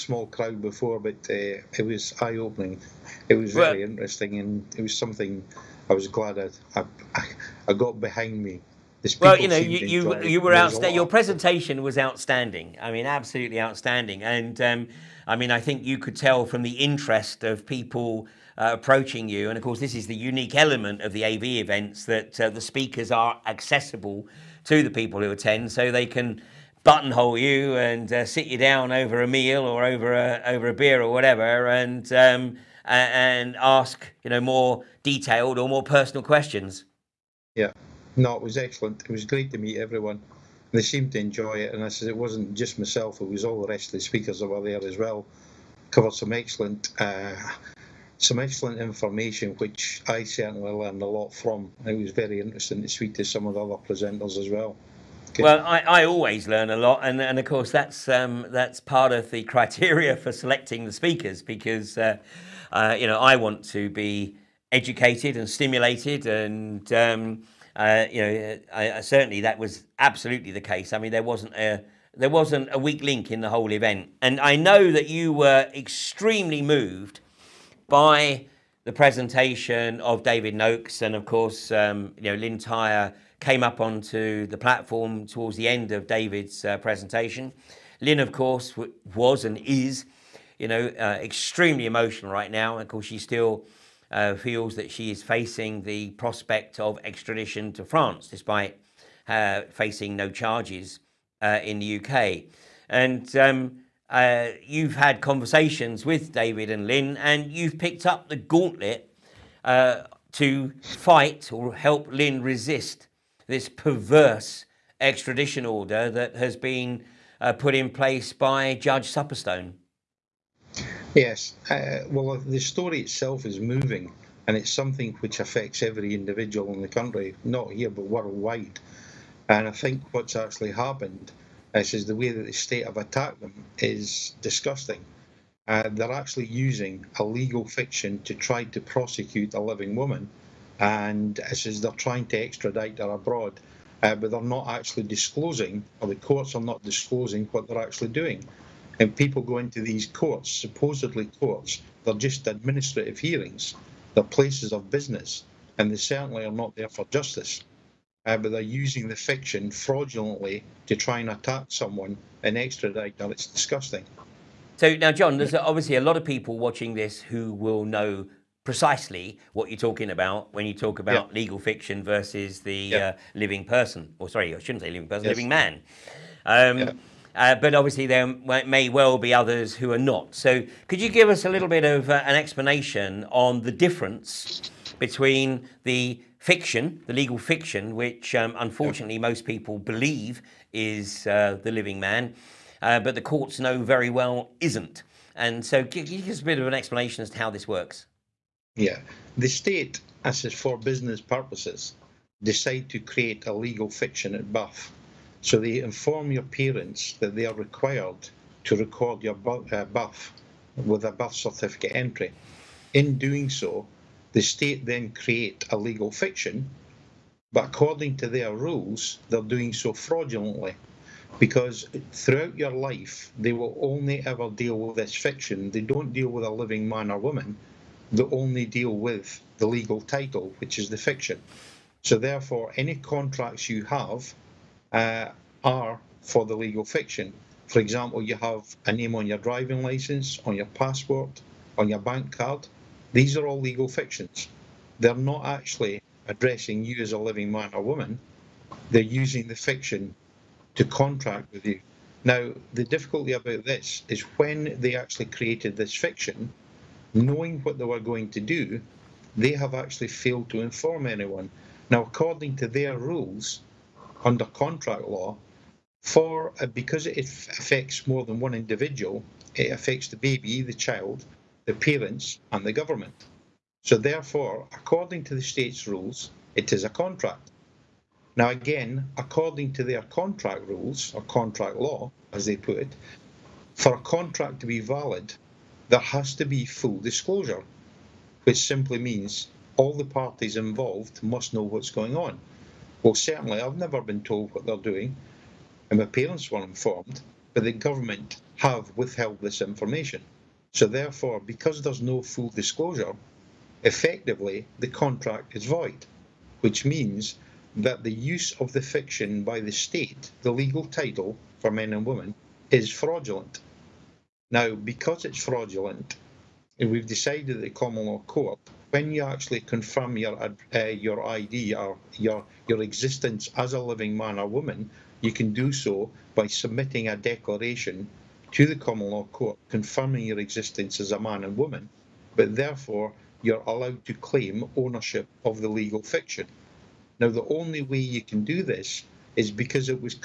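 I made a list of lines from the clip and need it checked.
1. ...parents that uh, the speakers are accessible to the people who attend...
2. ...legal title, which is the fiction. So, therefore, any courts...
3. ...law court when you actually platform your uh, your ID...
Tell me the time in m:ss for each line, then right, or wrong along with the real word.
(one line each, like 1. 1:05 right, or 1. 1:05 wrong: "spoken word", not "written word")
1. 0:21 wrong: "events", not "parents"
2. 3:49 wrong: "contracts", not "courts"
3. 5:18 wrong: "confirm", not "platform".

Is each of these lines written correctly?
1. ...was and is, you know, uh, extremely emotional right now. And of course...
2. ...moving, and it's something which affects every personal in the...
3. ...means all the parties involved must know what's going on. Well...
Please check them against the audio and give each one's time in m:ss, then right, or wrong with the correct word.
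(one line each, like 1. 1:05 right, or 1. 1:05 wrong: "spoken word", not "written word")
1. 1:29 right
2. 2:03 wrong: "individual", not "personal"
3. 4:48 right.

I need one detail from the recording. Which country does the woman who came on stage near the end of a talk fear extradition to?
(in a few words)
France.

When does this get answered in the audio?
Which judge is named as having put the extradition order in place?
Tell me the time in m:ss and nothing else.
1:58.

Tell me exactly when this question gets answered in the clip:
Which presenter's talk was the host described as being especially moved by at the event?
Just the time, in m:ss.
1:20.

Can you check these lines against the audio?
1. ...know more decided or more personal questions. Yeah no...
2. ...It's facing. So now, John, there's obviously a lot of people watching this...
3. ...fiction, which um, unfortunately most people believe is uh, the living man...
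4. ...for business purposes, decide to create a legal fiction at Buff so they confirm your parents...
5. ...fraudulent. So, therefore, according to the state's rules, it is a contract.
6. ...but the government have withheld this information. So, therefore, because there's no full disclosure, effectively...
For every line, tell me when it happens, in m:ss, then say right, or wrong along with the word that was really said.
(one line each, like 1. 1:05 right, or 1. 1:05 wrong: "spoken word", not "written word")
1. 0:34 wrong: "detailed", not "decided"
2. 2:43 wrong: "disgusting", not "facing"
3. 3:07 right
4. 3:20 wrong: "inform", not "confirm"
5. 4:32 wrong: "government", not "fraudulent"
6. 4:57 right.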